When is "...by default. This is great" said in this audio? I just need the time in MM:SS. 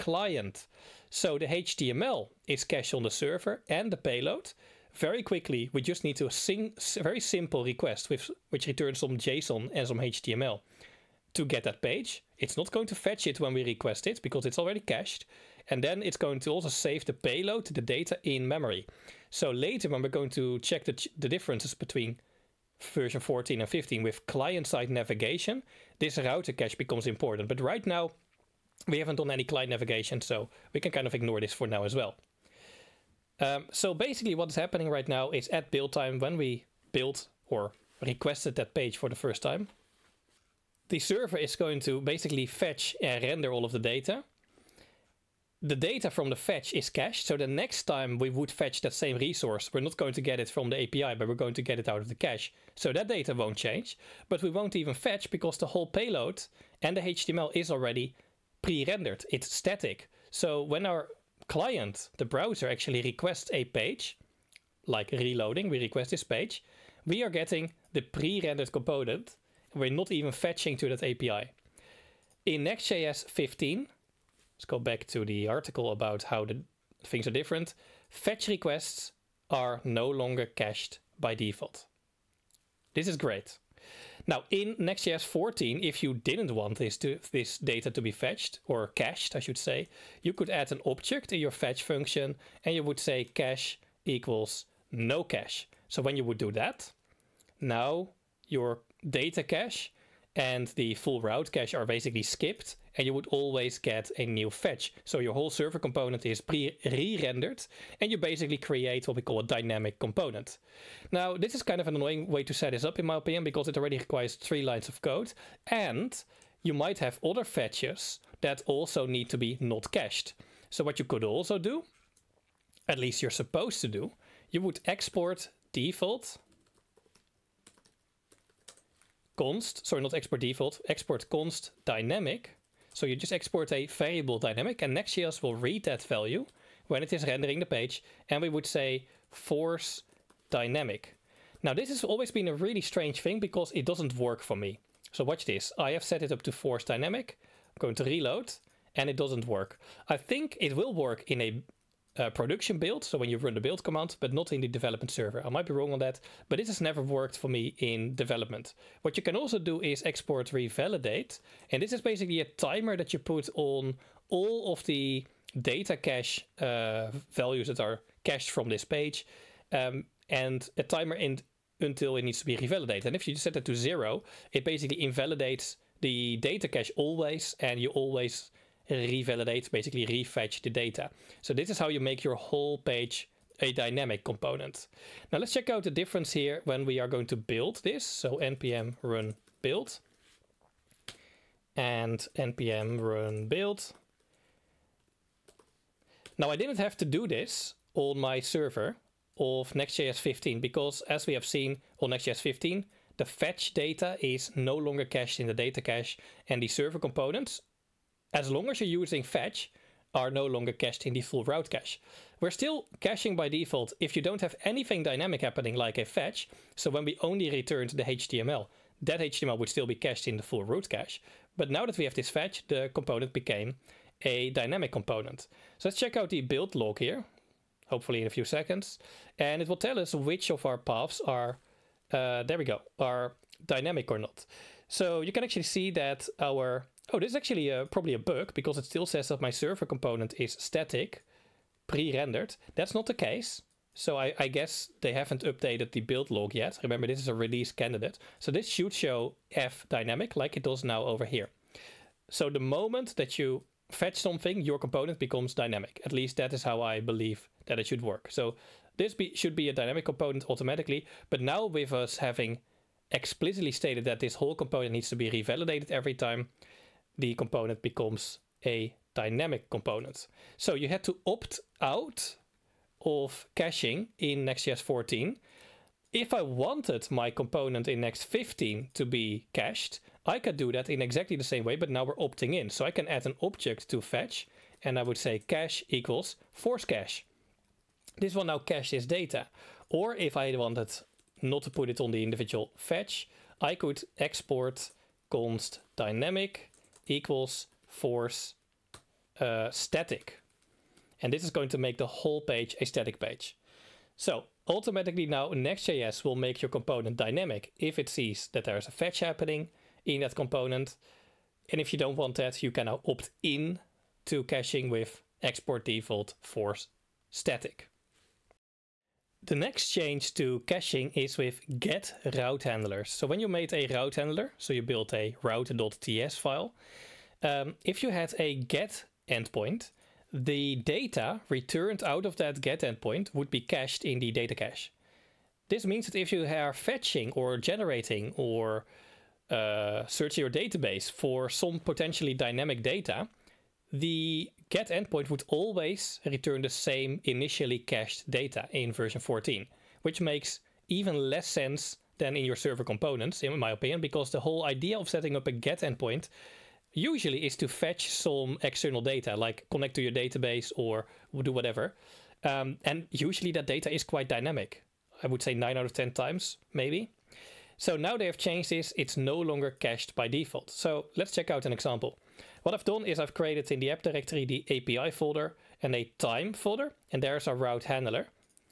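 01:21.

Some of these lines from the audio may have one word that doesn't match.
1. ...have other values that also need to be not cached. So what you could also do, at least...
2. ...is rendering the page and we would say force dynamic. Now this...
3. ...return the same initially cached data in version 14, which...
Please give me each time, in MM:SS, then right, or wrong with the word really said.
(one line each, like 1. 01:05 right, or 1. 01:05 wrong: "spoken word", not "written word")
1. 01:56 wrong: "fetches", not "values"
2. 02:17 right
3. 05:46 right.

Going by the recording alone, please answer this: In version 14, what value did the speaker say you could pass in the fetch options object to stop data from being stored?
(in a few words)
no cache.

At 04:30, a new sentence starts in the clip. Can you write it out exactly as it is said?
So you had to opt out of caching in Next.js 14.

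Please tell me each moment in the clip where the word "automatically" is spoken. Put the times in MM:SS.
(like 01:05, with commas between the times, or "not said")
04:20, 05:04.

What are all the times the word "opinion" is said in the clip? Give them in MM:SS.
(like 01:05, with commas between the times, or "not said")
01:53, 05:53.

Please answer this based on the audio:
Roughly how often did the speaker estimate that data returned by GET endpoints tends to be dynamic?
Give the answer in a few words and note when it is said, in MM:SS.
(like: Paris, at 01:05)
9 out of 10 times, at 06:05.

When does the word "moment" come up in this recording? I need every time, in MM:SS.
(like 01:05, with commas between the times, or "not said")
04:12.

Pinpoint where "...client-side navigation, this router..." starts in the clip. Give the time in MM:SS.
00:24.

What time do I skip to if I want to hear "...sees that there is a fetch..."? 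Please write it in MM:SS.
05:08.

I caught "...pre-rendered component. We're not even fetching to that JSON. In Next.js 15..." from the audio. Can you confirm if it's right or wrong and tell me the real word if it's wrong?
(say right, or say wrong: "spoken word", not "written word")
wrong: "API", not "JSON".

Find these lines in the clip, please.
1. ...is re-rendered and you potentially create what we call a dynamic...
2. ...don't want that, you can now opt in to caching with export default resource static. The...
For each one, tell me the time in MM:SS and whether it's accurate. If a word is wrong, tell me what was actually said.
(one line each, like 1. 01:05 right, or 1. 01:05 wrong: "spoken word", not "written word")
1. 01:46 wrong: "basically", not "potentially"
2. 05:11 wrong: "force", not "resource".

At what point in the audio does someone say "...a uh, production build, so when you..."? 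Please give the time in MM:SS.
02:31.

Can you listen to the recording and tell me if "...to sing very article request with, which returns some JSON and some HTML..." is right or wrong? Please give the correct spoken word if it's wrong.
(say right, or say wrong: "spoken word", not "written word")
wrong: "simple", not "article".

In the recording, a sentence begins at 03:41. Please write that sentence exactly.
But now that we have this fetch, the component became a dynamic component.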